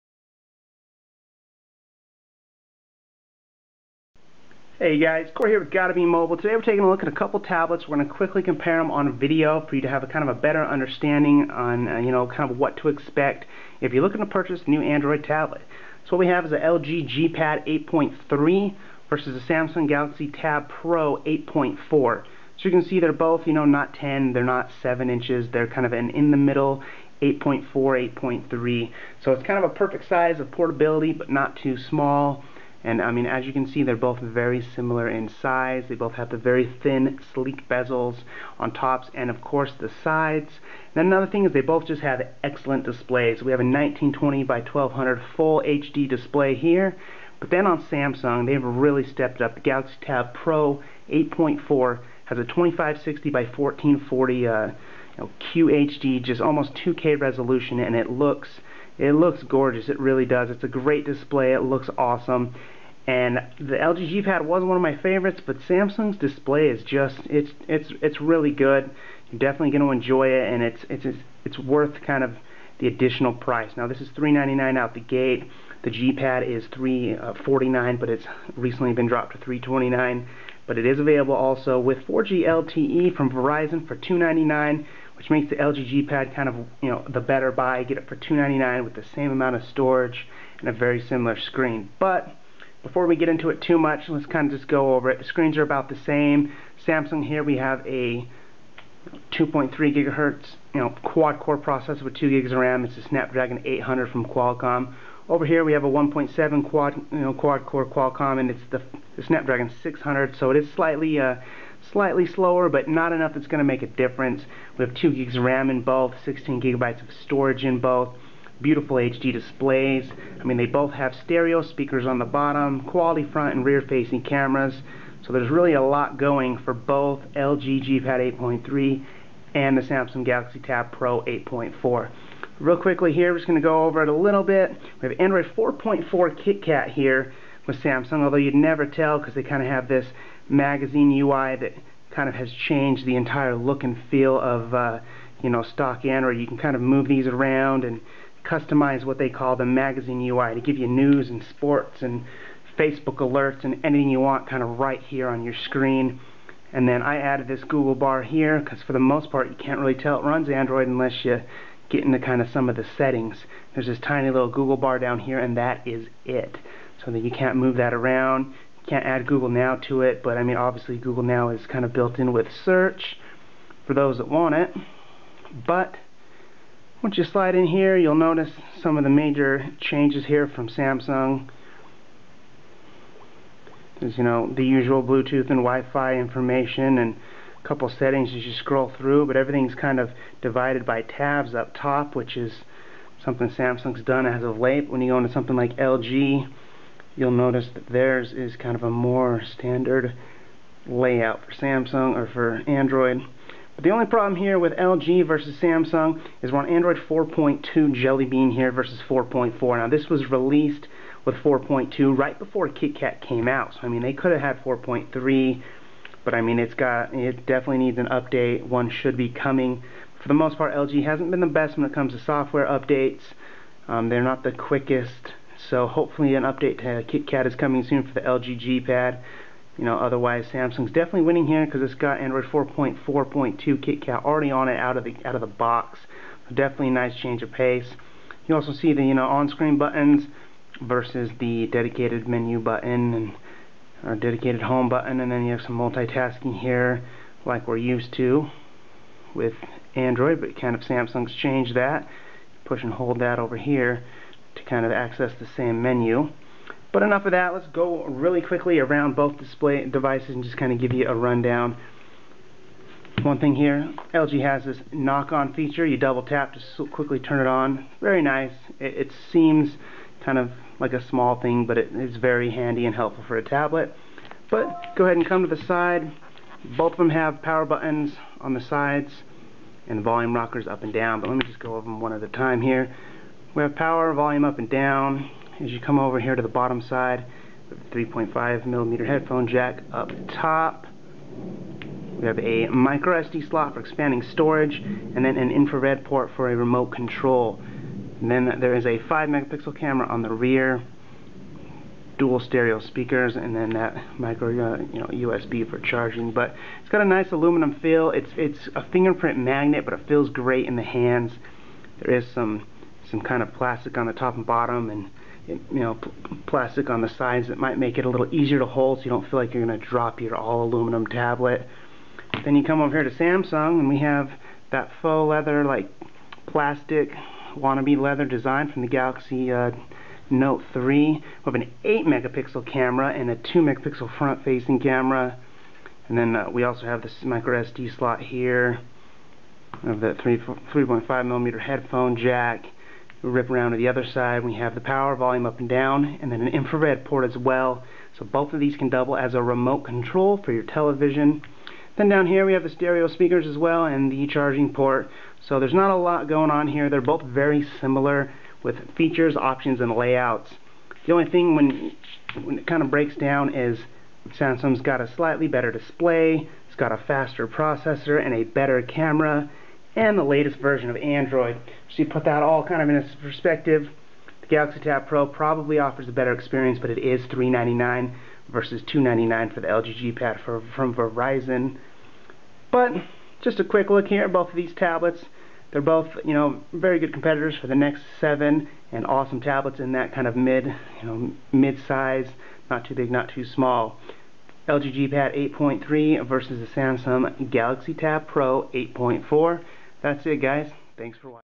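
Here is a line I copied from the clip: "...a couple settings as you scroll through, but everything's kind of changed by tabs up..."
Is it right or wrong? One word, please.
wrong.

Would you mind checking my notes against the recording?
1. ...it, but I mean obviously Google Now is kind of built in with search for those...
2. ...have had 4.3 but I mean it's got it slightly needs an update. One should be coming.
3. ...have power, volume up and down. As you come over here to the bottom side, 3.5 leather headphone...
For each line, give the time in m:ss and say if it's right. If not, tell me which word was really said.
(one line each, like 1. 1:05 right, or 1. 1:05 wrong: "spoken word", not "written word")
1. 2:50 right
2. 3:34 wrong: "definitely", not "slightly"
3. 4:43 wrong: "millimeter", not "leather".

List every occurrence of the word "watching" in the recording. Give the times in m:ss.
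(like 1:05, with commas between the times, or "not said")
6:41.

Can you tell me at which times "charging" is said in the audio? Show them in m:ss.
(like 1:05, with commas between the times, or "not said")
5:05, 5:54.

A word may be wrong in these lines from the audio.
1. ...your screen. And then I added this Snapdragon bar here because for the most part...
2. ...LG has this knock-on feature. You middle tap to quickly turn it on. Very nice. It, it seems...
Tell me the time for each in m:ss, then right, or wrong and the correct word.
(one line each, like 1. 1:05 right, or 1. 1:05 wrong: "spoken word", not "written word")
1. 2:35 wrong: "Google", not "Snapdragon"
2. 4:24 wrong: "double", not "middle".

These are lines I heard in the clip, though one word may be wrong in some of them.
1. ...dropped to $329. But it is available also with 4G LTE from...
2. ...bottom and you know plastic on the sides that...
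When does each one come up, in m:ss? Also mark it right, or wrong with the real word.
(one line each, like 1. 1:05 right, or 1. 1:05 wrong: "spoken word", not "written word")
1. 1:19 right
2. 5:14 right.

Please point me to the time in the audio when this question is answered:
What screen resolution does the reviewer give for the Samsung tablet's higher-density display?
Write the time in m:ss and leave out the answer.
0:52.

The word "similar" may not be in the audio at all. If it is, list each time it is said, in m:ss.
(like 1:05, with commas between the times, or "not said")
0:34, 1:30, 5:57.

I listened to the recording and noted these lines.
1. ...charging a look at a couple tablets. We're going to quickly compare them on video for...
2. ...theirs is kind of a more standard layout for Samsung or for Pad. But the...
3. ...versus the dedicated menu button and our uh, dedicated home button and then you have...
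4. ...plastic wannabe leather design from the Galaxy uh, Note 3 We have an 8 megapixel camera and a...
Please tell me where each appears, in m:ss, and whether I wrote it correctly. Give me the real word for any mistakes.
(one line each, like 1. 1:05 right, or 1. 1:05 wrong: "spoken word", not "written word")
1. 0:06 wrong: "taking", not "charging"
2. 3:17 wrong: "Android", not "Pad"
3. 4:00 right
4. 5:26 right.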